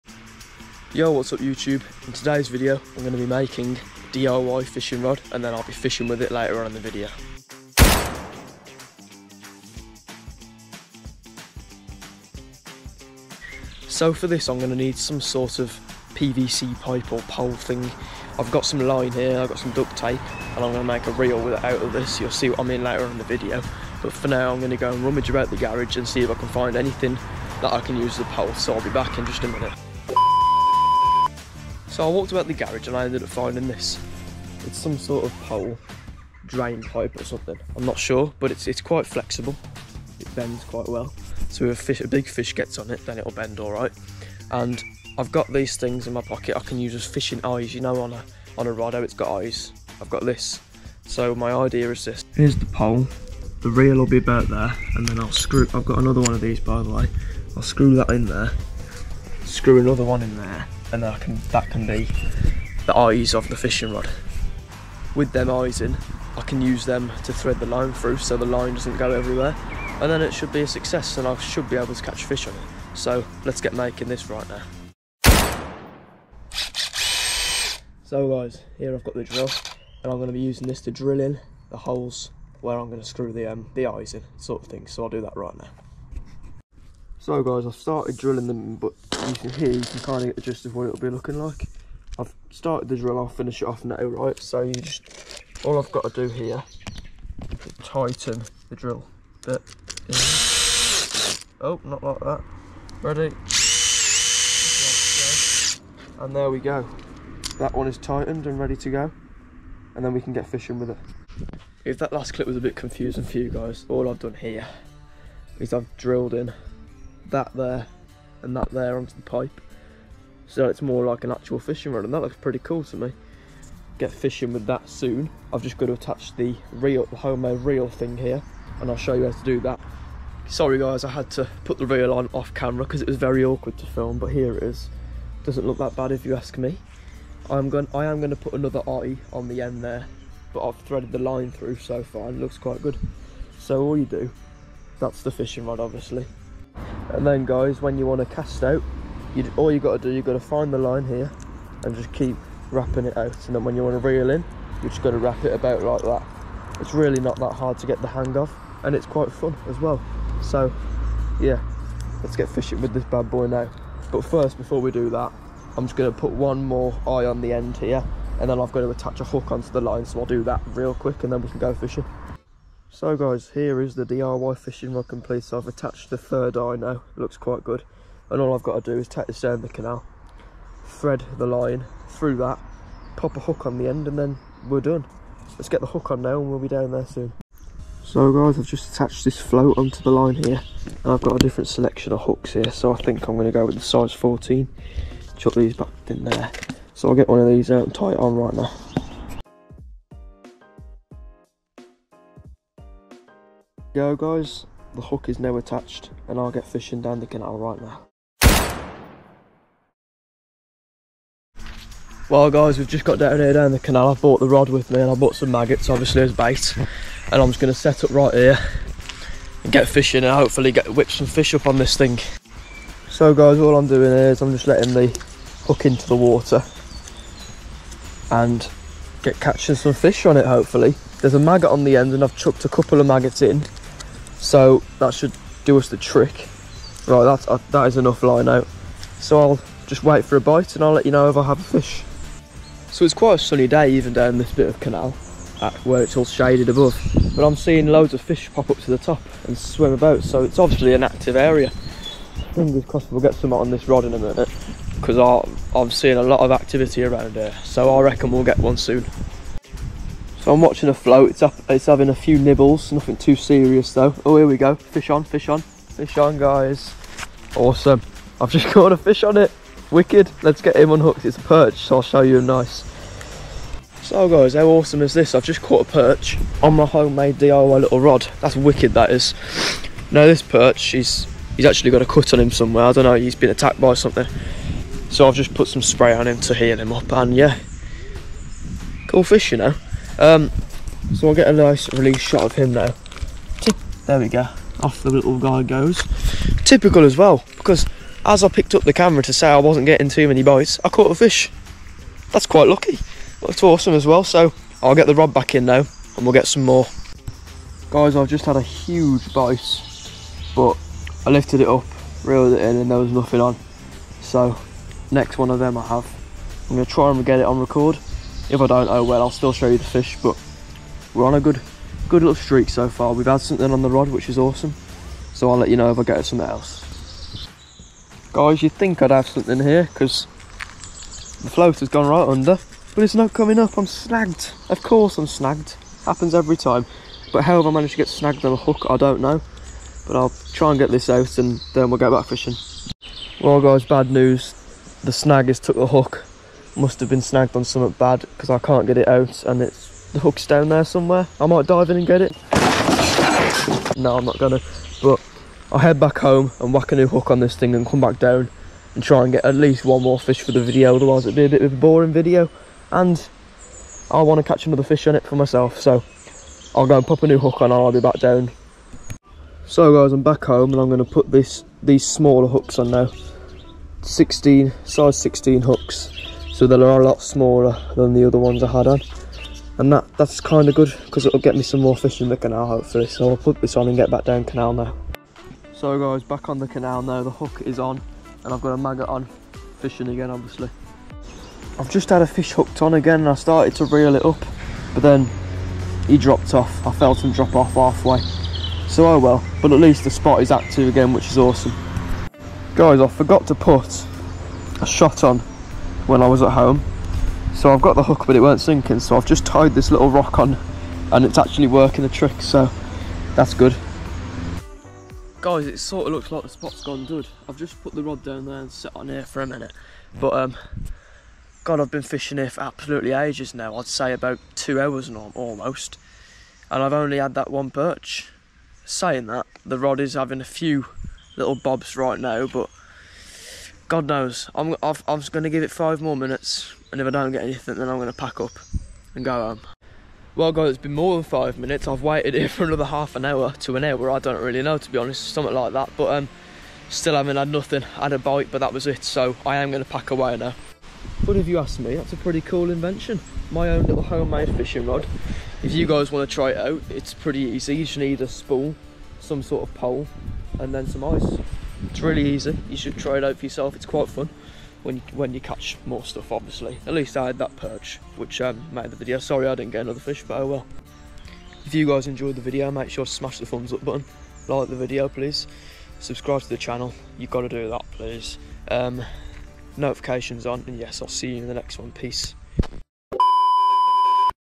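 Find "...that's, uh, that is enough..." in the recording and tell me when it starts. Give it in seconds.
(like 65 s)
237 s.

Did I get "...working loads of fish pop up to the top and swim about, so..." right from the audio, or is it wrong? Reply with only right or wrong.
wrong.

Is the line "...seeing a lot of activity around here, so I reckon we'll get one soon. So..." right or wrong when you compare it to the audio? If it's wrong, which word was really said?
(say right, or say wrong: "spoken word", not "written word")
right.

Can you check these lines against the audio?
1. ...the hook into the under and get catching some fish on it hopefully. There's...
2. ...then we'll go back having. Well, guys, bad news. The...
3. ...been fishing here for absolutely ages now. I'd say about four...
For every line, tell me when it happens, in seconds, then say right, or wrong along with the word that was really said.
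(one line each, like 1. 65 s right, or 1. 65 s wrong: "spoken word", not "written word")
1. 224 s wrong: "water", not "under"
2. 341 s wrong: "fishing", not "having"
3. 421 s wrong: "two", not "four".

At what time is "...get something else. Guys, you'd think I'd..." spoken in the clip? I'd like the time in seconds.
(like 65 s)
326 s.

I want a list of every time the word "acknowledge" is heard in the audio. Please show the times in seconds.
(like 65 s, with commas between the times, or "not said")
not said.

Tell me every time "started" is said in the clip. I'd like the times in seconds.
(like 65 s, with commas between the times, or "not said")
87 s, 92 s, 393 s.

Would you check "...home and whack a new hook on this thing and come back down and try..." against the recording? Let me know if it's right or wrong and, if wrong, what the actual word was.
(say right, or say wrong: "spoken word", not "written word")
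right.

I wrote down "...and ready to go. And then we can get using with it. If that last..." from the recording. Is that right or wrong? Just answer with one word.
wrong.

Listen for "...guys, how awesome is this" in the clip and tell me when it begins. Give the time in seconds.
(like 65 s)
274 s.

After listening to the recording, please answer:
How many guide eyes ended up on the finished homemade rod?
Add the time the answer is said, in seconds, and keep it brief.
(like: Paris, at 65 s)
3, at 176 s.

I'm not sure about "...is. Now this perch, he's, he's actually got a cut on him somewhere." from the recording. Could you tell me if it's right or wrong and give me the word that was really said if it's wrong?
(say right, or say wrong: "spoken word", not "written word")
right.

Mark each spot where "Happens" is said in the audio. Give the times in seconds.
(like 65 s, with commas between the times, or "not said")
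336 s.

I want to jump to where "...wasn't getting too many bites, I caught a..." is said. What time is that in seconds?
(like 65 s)
299 s.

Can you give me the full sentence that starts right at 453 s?
My own little homemade fishing rod.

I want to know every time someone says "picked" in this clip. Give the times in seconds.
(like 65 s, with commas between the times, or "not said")
298 s.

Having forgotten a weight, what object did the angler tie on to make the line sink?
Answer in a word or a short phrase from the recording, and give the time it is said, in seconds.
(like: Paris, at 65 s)
little rock, at 409 s.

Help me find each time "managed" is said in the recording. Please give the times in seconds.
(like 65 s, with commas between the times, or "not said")
337 s.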